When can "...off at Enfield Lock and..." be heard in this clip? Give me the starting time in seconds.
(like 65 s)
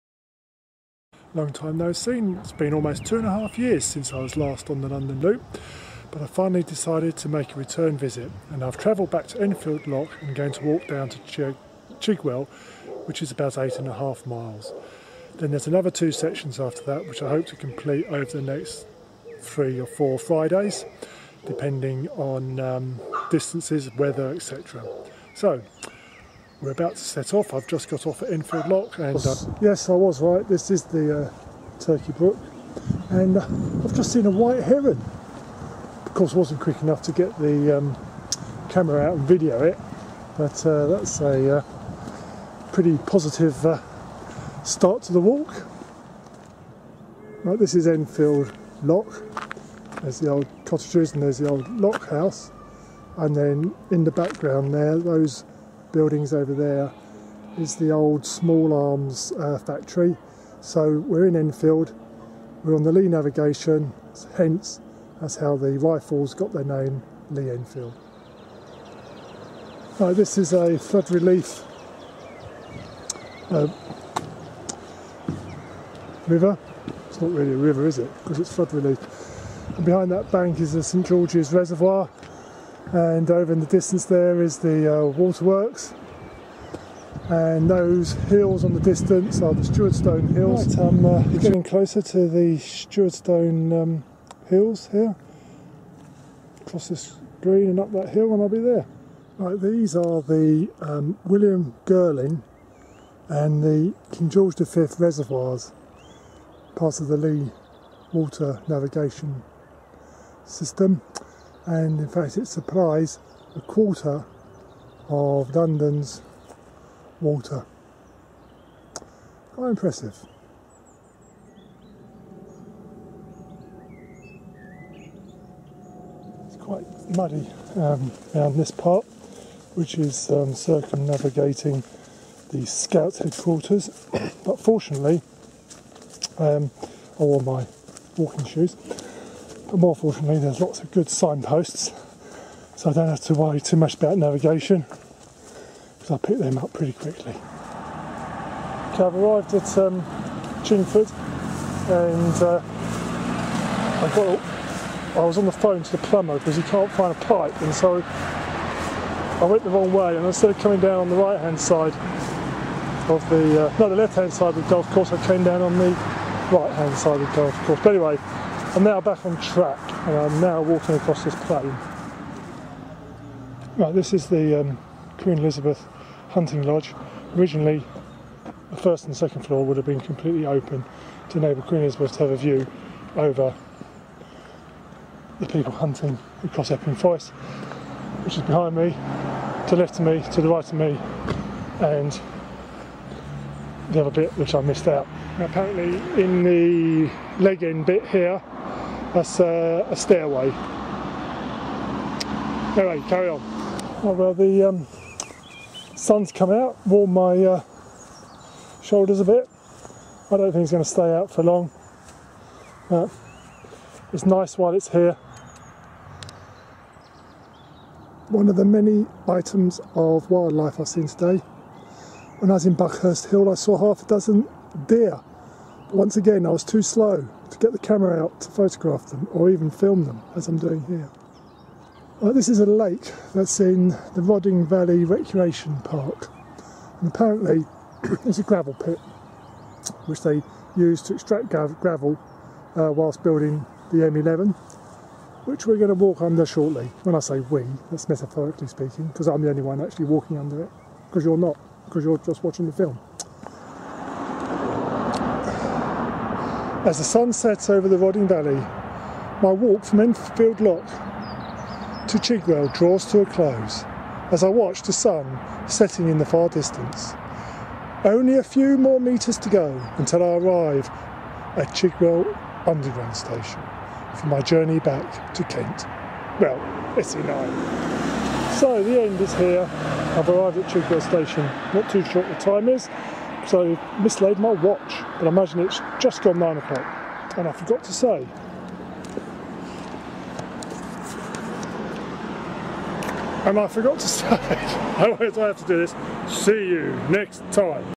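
28 s.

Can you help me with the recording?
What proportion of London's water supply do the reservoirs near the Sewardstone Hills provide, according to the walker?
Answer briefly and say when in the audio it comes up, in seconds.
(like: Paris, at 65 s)
a quarter, at 113 s.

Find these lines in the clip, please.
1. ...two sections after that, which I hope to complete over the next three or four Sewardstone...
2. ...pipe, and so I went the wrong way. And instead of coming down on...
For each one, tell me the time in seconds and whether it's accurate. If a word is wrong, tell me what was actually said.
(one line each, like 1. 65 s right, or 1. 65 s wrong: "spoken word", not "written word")
1. 15 s wrong: "Fridays", not "Sewardstone"
2. 157 s right.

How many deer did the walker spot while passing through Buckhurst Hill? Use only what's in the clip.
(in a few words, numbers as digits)
half a dozen.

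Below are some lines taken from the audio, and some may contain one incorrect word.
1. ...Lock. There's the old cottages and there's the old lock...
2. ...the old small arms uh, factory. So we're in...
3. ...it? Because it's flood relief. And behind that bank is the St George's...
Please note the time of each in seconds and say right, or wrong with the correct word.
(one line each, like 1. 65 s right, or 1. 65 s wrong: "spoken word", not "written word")
1. 48 s right
2. 57 s right
3. 77 s right.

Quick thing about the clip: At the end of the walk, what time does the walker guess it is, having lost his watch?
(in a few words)
9 o'clock.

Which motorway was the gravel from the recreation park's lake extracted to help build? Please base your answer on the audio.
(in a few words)
M11.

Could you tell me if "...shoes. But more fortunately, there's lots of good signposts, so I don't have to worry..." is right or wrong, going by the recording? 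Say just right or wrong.
right.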